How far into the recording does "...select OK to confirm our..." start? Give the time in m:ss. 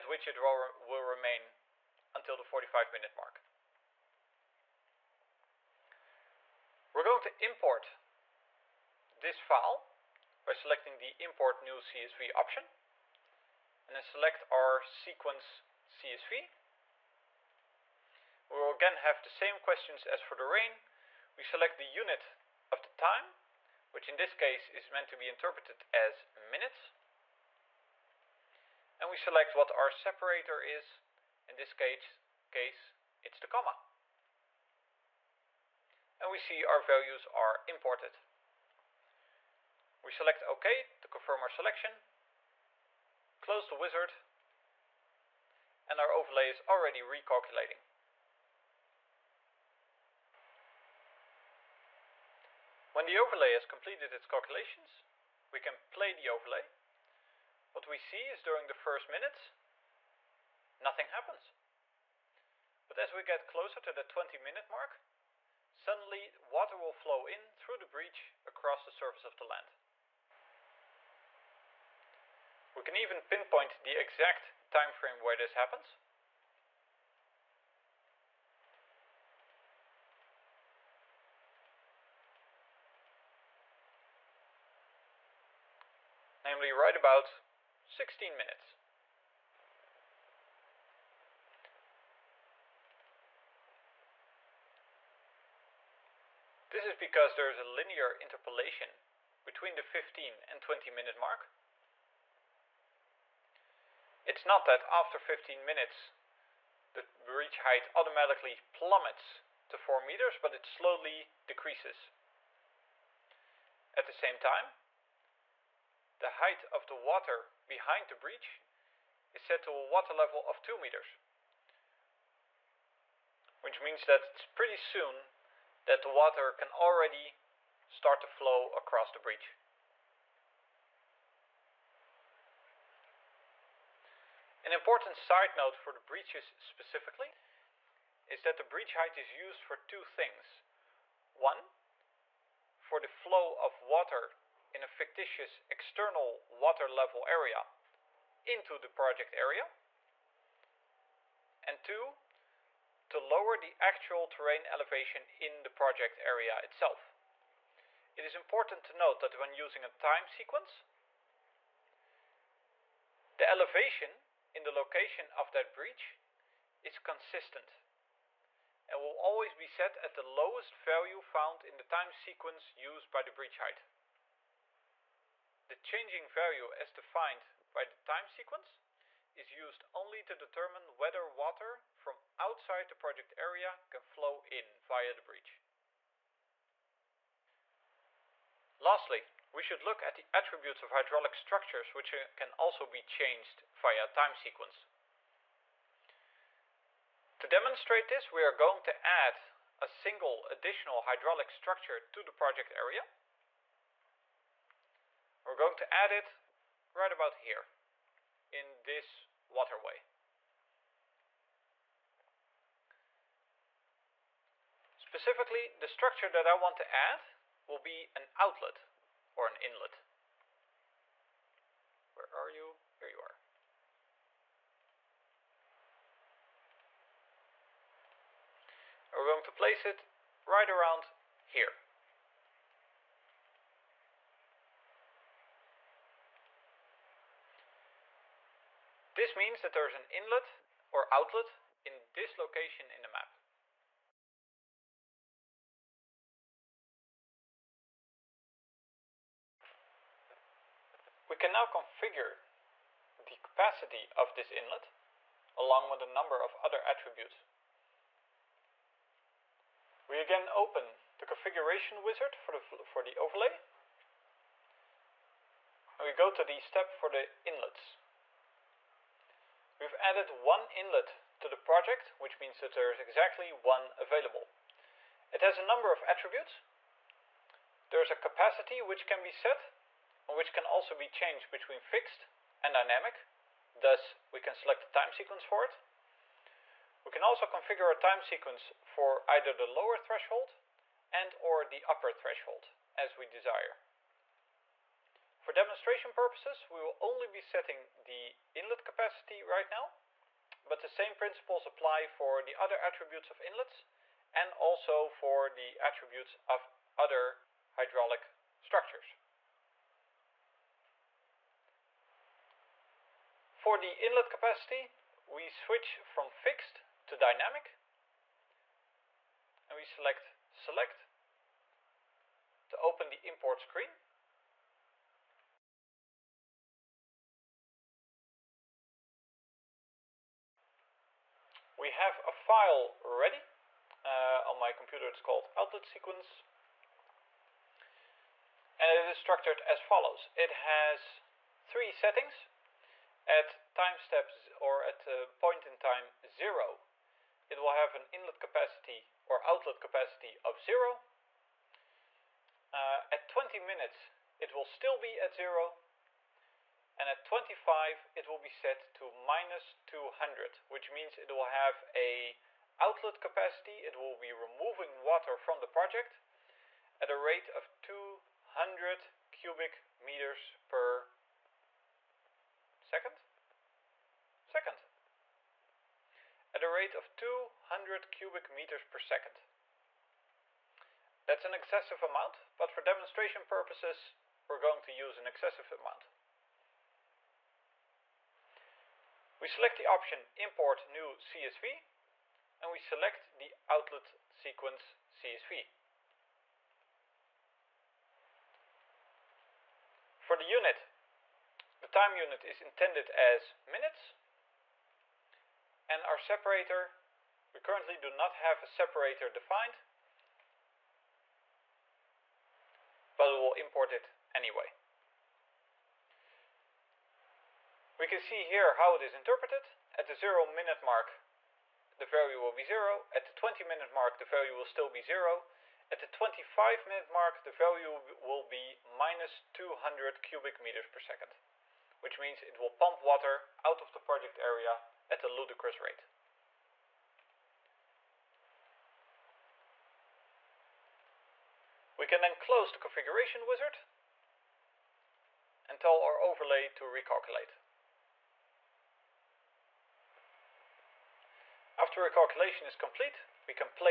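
0:40.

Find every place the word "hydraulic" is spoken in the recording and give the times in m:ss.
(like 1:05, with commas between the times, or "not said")
3:10, 3:21, 5:07.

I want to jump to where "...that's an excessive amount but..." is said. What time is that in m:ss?
6:21.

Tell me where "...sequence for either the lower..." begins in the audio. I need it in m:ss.
4:48.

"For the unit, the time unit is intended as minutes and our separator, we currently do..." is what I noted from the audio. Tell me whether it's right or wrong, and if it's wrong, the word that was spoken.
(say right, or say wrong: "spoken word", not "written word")
right.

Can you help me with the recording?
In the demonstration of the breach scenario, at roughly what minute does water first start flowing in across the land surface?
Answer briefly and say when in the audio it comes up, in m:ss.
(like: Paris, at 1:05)
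16 minutes, at 1:26.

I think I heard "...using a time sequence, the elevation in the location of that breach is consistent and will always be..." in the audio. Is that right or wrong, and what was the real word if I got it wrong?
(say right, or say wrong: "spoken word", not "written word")
right.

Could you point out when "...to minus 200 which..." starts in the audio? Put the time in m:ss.
5:58.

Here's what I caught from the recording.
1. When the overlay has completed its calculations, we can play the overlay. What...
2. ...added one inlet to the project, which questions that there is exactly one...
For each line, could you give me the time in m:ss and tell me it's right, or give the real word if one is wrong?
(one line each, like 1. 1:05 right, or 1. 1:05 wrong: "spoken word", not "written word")
1. 0:52 right
2. 4:29 wrong: "means", not "questions".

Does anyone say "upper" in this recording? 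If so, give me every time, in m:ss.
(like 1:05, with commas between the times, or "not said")
4:51.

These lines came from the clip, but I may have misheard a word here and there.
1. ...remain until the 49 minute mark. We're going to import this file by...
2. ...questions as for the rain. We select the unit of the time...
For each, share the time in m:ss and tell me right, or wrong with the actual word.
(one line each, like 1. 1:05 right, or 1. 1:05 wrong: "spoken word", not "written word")
1. 0:01 wrong: "45", not "49"
2. 0:19 right.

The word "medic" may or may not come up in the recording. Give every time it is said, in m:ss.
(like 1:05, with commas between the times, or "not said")
not said.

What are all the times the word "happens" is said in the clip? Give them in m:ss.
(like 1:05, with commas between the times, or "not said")
1:01, 1:15.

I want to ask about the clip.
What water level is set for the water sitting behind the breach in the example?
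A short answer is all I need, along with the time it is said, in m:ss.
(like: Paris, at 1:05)
2 meters, at 2:00.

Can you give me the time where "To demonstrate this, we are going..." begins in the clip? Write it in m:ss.
3:17.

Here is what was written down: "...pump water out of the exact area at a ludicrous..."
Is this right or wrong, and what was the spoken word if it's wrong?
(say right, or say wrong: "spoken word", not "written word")
wrong: "project", not "exact".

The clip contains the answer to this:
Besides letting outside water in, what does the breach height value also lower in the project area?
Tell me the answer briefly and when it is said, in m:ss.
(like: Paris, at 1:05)
terrain elevation, at 2:34.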